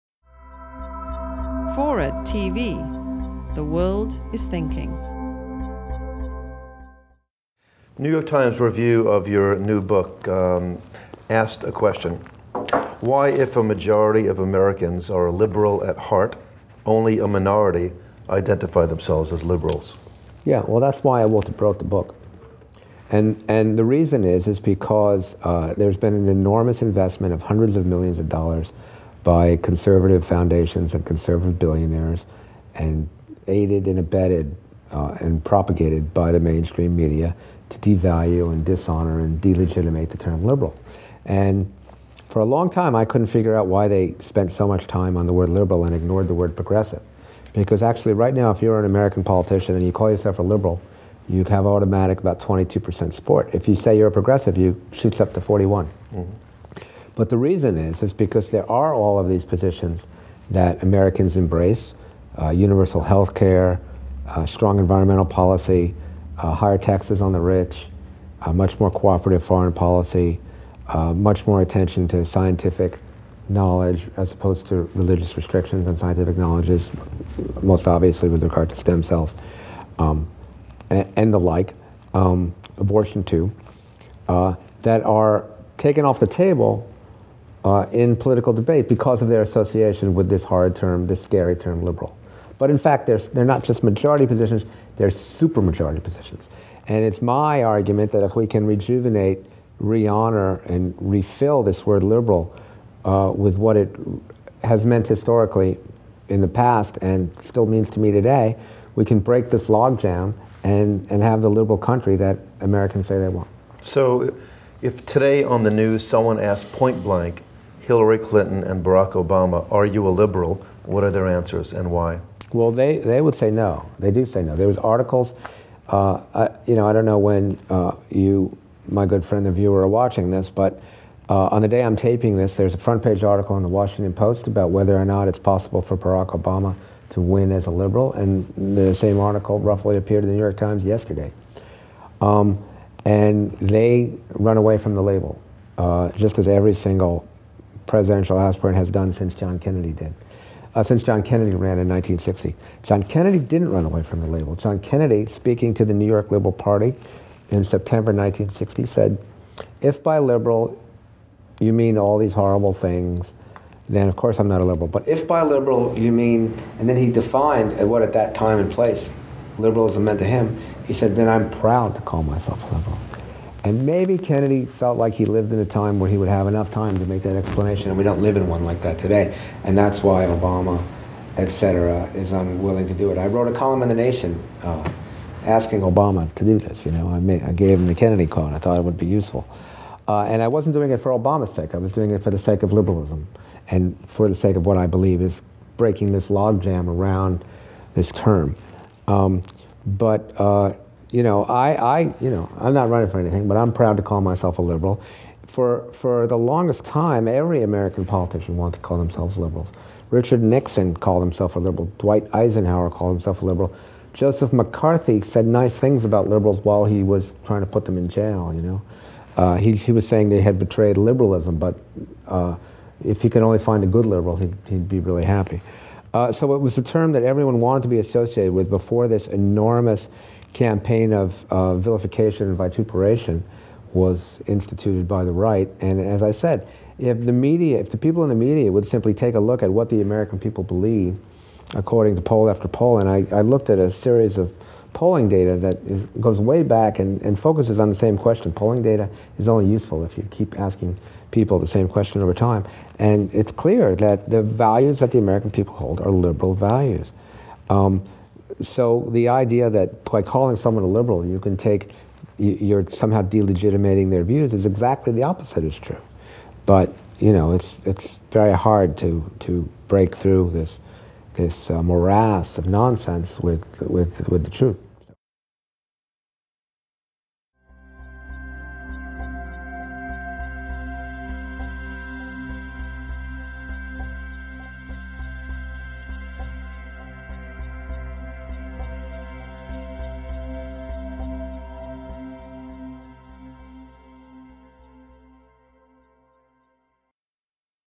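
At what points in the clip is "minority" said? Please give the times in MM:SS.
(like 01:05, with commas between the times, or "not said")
00:17.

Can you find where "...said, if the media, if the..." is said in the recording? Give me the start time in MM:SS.
03:56.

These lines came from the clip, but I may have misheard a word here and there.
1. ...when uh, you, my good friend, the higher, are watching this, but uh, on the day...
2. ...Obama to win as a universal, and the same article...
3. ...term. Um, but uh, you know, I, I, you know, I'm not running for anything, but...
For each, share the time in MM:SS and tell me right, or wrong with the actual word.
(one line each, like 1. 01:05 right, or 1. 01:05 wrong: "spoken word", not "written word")
1. 02:07 wrong: "viewer", not "higher"
2. 02:16 wrong: "liberal", not "universal"
3. 03:18 right.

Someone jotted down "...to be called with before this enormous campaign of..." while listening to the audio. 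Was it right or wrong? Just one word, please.
wrong.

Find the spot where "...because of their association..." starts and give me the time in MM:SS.
01:28.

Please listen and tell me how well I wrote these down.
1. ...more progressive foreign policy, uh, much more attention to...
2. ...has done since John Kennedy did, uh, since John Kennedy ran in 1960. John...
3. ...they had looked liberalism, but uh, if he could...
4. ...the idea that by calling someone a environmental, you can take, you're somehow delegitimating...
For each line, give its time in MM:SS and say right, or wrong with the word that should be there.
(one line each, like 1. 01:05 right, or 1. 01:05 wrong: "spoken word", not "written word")
1. 01:08 wrong: "cooperative", not "progressive"
2. 02:28 right
3. 03:40 wrong: "betrayed", not "looked"
4. 04:19 wrong: "liberal", not "environmental".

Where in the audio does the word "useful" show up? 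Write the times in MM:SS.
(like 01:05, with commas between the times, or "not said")
03:09, 04:09.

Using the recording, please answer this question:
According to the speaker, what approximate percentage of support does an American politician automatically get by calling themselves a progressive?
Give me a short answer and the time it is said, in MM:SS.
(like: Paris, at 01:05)
41%, at 00:55.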